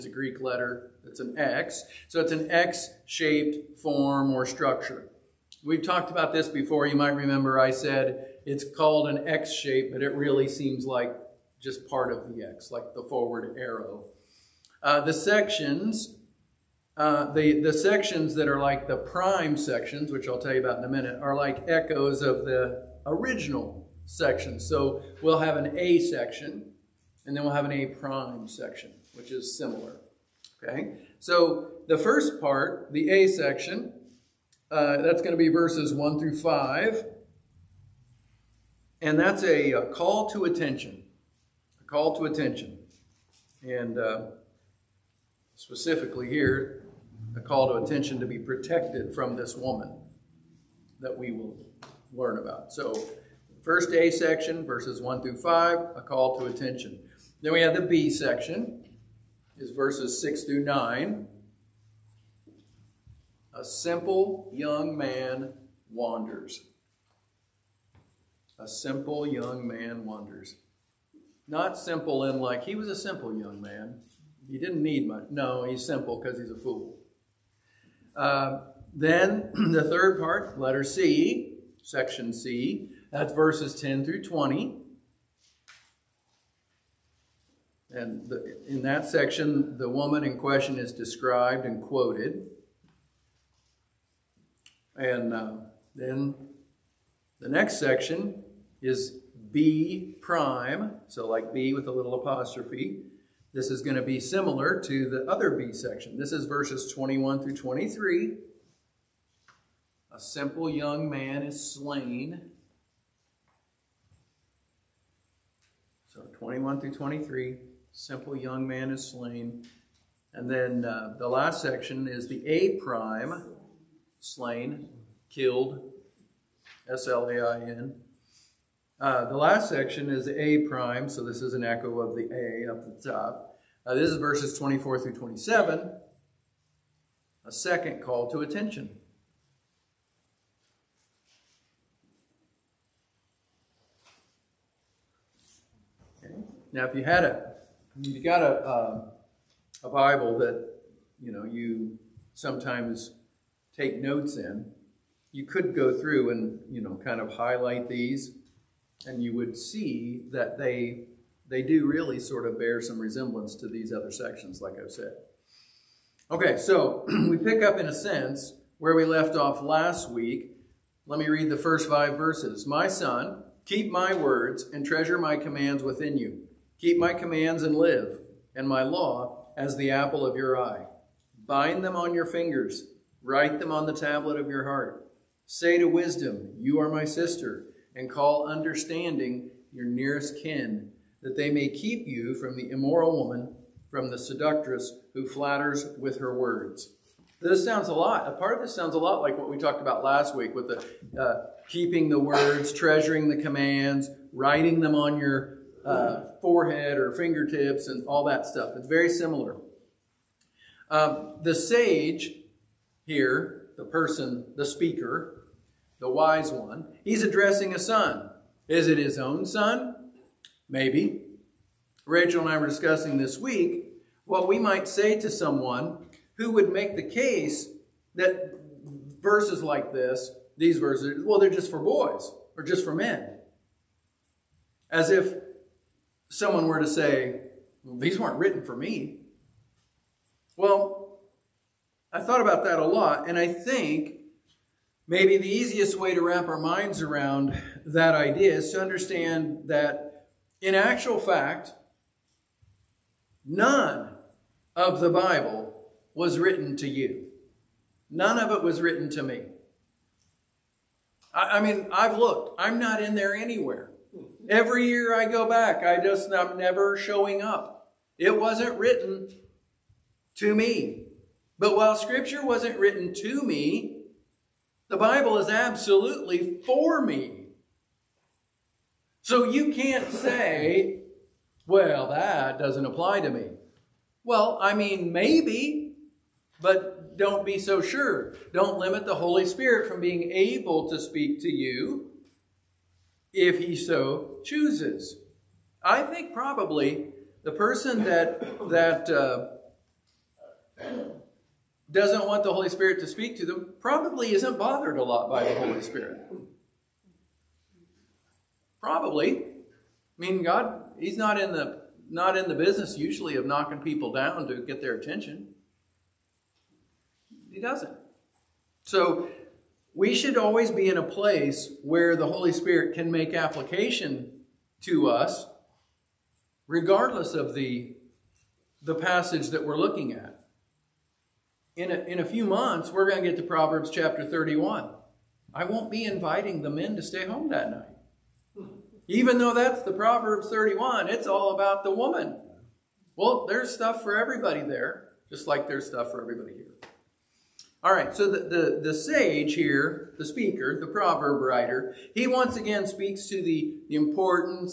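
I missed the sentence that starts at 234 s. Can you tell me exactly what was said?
As if someone were to say, well, these weren't written for me.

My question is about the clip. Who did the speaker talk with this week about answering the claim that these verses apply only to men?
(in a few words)
Rachel.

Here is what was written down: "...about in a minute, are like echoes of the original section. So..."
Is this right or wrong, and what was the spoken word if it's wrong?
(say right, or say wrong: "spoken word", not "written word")
right.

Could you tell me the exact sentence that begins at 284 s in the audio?
Well, I mean, maybe, but don't be so sure.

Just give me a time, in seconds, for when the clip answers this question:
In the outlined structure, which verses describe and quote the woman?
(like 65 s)
83 s.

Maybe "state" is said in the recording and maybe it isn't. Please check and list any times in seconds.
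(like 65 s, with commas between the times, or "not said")
not said.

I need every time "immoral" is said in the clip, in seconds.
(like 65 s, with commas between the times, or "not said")
192 s.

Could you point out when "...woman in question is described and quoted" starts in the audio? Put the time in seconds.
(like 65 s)
89 s.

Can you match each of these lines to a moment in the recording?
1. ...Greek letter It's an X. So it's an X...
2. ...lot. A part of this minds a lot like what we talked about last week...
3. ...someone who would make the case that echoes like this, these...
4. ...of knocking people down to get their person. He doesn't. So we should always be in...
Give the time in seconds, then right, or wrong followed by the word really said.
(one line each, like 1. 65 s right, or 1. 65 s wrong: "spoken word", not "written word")
1. 0 s right
2. 197 s wrong: "sounds", not "minds"
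3. 225 s wrong: "verses", not "echoes"
4. 313 s wrong: "attention", not "person".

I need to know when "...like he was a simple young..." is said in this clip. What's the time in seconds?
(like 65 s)
72 s.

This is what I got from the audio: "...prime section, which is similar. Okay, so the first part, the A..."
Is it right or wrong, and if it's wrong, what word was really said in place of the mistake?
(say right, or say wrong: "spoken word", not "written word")
right.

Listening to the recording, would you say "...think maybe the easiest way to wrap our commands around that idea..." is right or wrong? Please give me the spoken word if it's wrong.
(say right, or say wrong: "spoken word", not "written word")
wrong: "minds", not "commands".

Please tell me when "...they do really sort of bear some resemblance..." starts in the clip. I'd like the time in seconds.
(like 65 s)
161 s.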